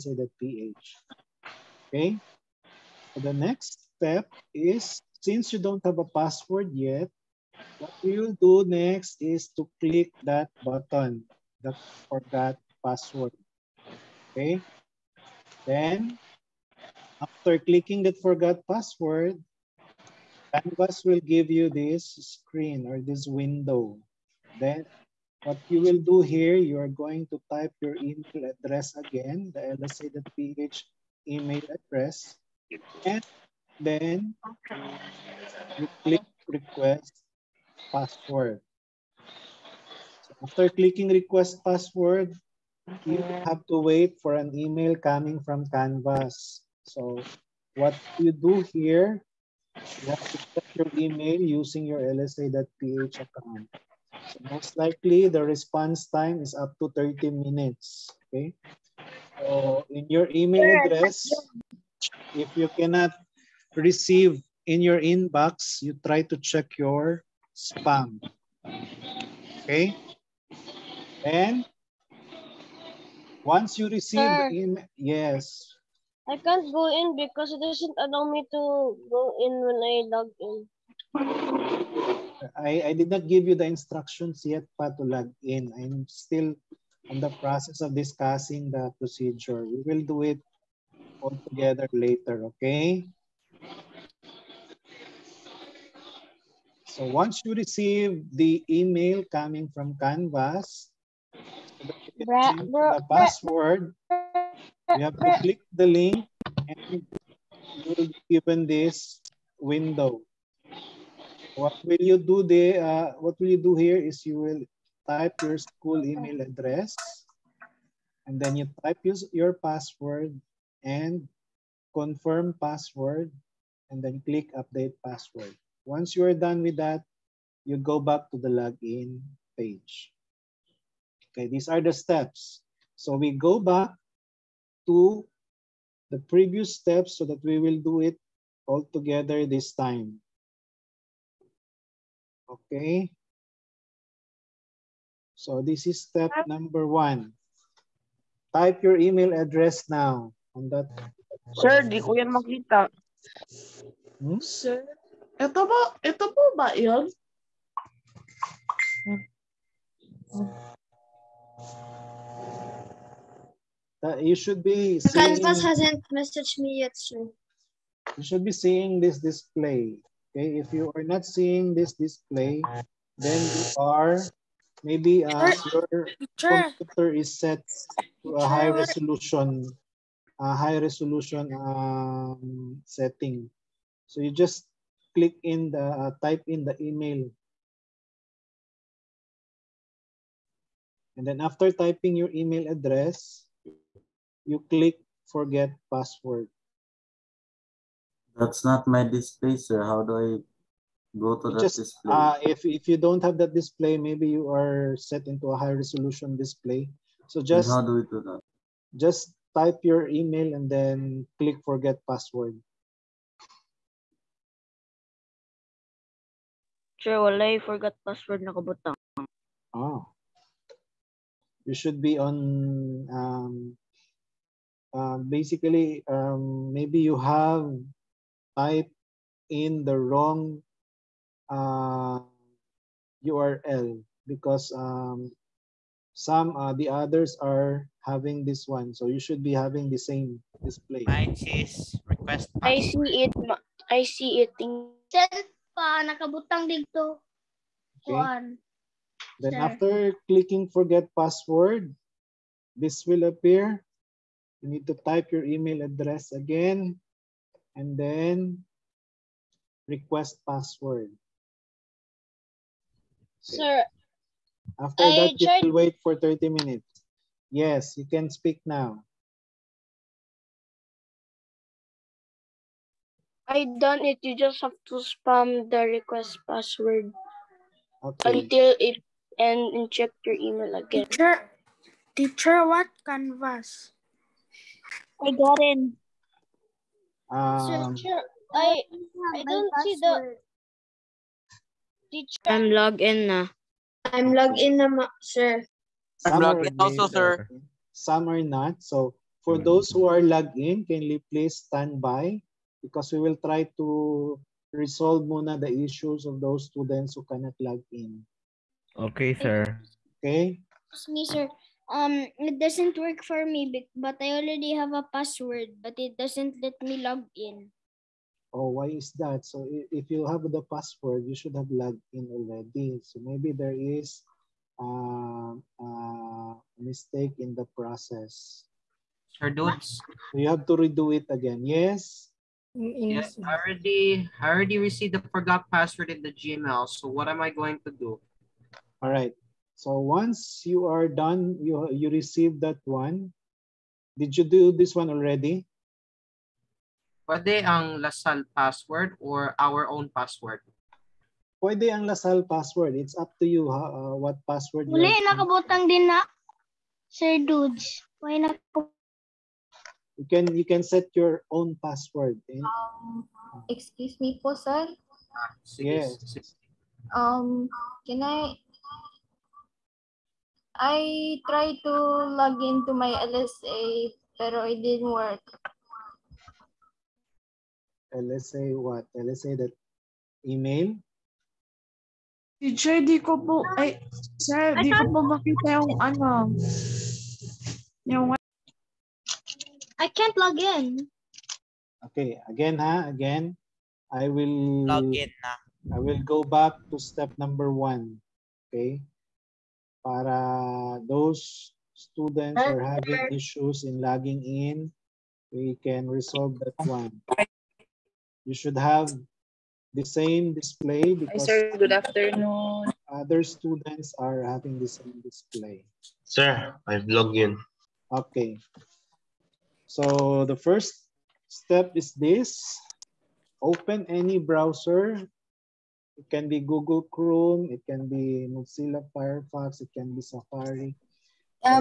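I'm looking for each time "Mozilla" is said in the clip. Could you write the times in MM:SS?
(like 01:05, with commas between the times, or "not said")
07:08.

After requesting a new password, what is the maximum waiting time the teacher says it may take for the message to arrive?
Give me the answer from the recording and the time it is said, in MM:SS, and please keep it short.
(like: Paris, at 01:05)
30 minutes, at 00:56.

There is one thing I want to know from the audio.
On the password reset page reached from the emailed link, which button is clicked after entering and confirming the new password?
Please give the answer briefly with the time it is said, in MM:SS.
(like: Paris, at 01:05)
update password, at 02:04.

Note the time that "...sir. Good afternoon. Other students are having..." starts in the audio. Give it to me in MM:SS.
06:51.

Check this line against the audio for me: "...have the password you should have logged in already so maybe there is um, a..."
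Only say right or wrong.
right.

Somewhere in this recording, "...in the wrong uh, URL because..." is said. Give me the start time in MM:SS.
03:49.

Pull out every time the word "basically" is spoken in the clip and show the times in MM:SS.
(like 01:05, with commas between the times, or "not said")
03:45.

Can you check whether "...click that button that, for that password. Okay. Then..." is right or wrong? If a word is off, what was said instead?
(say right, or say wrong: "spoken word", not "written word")
right.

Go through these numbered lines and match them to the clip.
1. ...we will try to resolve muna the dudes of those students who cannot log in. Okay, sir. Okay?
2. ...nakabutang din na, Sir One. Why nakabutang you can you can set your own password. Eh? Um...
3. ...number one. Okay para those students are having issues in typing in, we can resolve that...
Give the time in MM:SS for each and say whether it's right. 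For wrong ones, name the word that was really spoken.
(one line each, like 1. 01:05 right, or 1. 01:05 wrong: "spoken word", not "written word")
1. 05:03 wrong: "issues", not "dudes"
2. 05:55 wrong: "Dudes", not "One"
3. 06:37 wrong: "logging", not "typing".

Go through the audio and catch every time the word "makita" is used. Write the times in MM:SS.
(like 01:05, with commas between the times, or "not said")
02:32, 06:25.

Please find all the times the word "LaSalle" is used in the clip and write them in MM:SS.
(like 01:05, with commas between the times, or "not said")
05:47, 05:52.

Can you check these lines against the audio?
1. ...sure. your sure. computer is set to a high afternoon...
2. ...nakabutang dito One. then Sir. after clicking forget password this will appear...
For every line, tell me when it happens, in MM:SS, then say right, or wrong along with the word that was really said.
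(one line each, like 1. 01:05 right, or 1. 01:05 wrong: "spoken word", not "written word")
1. 02:55 wrong: "resolution", not "afternoon"
2. 04:06 right.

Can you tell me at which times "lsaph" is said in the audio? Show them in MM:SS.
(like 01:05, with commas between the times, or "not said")
00:29, 00:52.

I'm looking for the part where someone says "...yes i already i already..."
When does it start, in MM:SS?
05:33.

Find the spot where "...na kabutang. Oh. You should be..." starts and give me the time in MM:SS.
03:38.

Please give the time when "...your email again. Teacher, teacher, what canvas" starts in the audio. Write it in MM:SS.
04:40.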